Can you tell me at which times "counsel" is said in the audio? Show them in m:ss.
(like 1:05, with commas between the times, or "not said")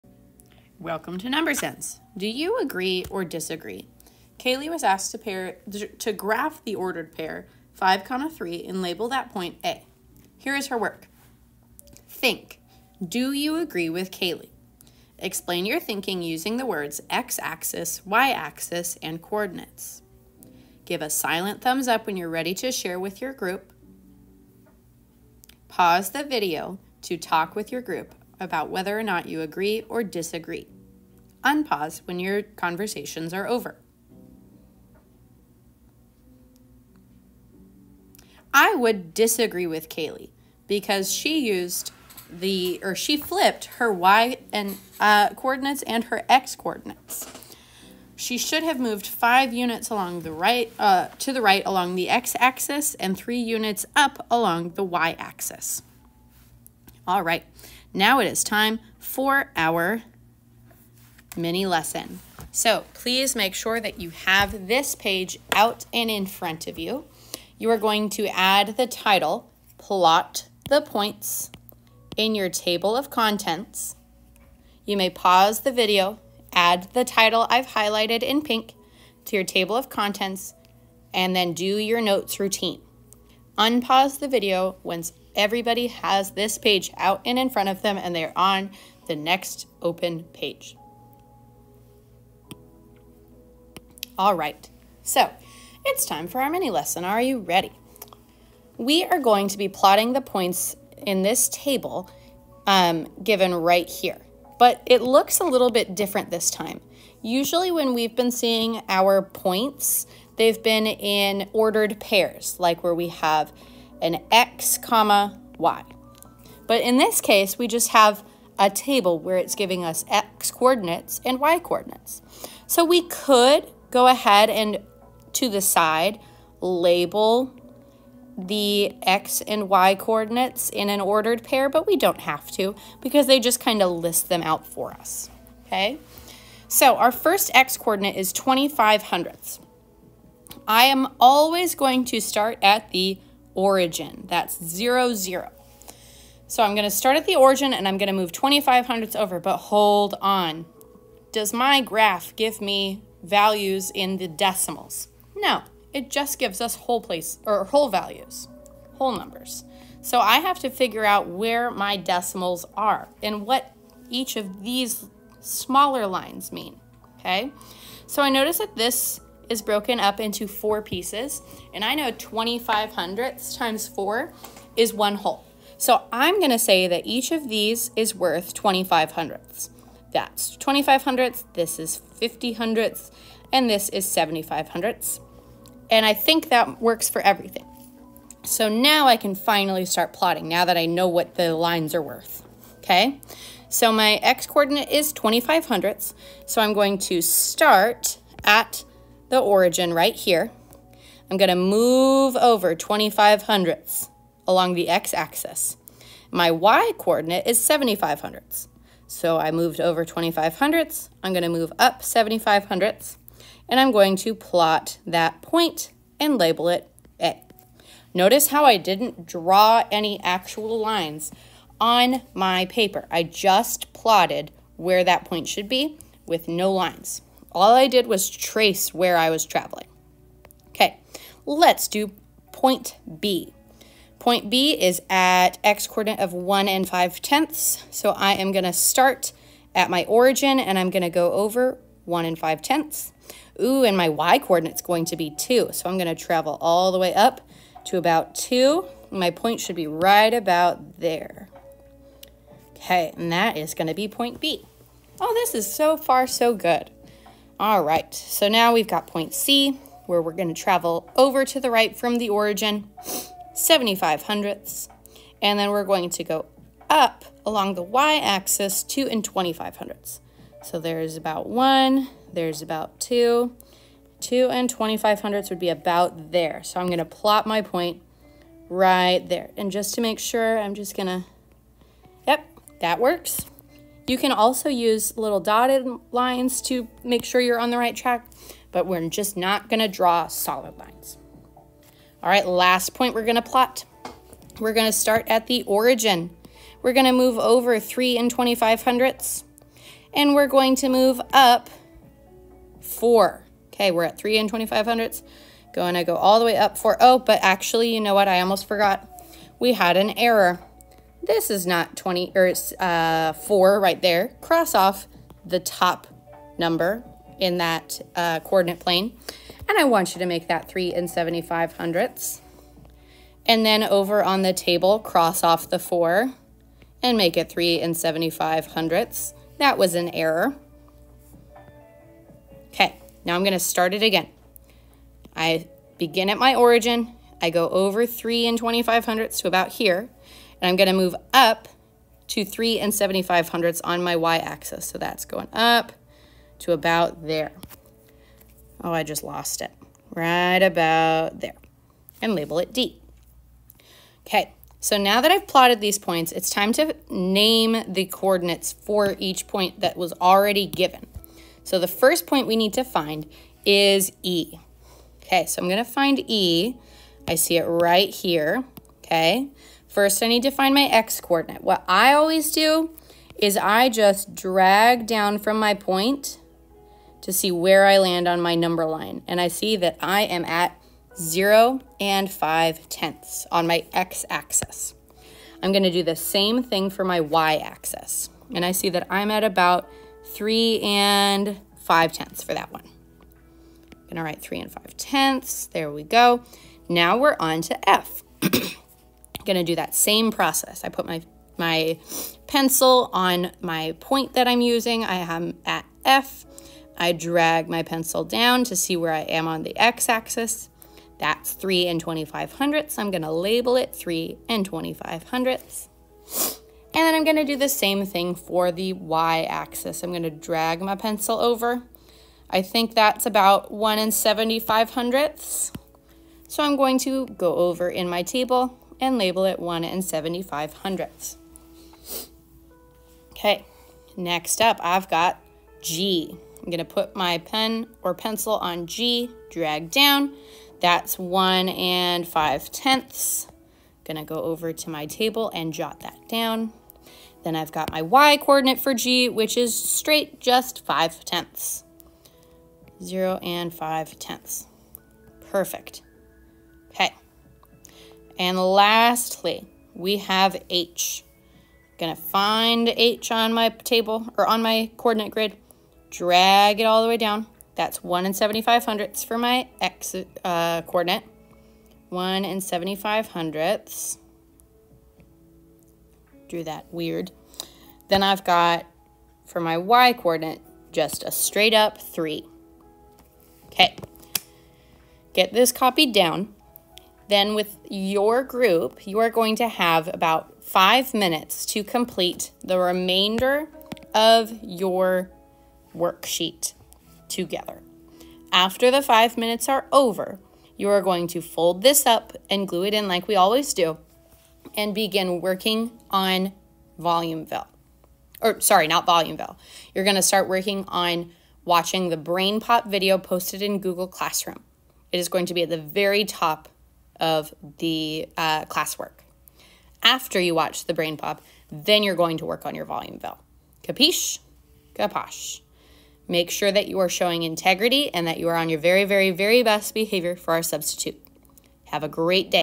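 not said.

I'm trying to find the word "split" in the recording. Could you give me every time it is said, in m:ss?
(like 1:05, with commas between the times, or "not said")
not said.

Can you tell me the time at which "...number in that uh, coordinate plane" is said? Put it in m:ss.
5:16.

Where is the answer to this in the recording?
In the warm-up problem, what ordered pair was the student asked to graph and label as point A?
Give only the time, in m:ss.
0:07.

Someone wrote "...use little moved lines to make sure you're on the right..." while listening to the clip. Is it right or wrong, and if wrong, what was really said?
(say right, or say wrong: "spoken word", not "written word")
wrong: "dotted", not "moved".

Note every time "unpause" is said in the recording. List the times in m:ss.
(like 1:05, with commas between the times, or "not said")
0:31, 1:23.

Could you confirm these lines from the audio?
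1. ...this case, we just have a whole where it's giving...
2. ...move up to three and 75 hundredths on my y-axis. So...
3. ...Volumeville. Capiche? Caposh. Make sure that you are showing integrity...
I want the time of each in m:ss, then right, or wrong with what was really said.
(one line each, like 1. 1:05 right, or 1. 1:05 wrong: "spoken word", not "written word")
1. 1:56 wrong: "table", not "whole"
2. 5:40 right
3. 8:42 right.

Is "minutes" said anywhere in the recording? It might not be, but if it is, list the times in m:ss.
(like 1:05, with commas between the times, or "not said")
8:11, 8:19.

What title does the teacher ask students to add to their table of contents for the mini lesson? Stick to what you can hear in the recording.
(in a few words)
Plot the points.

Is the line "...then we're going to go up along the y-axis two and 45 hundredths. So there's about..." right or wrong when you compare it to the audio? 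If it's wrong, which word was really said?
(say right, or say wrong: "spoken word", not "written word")
wrong: "25", not "45".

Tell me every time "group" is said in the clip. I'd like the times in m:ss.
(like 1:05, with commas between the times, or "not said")
0:23, 0:27, 8:08.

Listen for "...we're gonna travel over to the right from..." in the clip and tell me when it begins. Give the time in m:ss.
4:20.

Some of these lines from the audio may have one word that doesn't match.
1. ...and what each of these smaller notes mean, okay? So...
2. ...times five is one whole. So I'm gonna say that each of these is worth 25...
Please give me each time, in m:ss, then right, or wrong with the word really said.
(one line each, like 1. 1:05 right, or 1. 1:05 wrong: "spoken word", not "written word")
1. 2:43 wrong: "lines", not "notes"
2. 2:53 wrong: "four", not "five".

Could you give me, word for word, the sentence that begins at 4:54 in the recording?
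We're gonna start at the origin.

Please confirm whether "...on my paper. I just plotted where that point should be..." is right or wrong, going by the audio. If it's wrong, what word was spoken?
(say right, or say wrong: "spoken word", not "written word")
right.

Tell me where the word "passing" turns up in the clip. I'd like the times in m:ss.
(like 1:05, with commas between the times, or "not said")
not said.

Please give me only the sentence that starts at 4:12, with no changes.
Okay, and that is going to be point B.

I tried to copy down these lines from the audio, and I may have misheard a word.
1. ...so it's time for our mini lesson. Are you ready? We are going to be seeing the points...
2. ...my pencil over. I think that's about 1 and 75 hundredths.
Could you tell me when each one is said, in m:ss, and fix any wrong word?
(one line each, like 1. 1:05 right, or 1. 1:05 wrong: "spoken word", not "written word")
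1. 1:35 wrong: "plotting", not "seeing"
2. 7:00 right.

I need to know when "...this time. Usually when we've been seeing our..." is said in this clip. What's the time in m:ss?
1:46.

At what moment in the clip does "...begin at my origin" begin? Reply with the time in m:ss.
5:35.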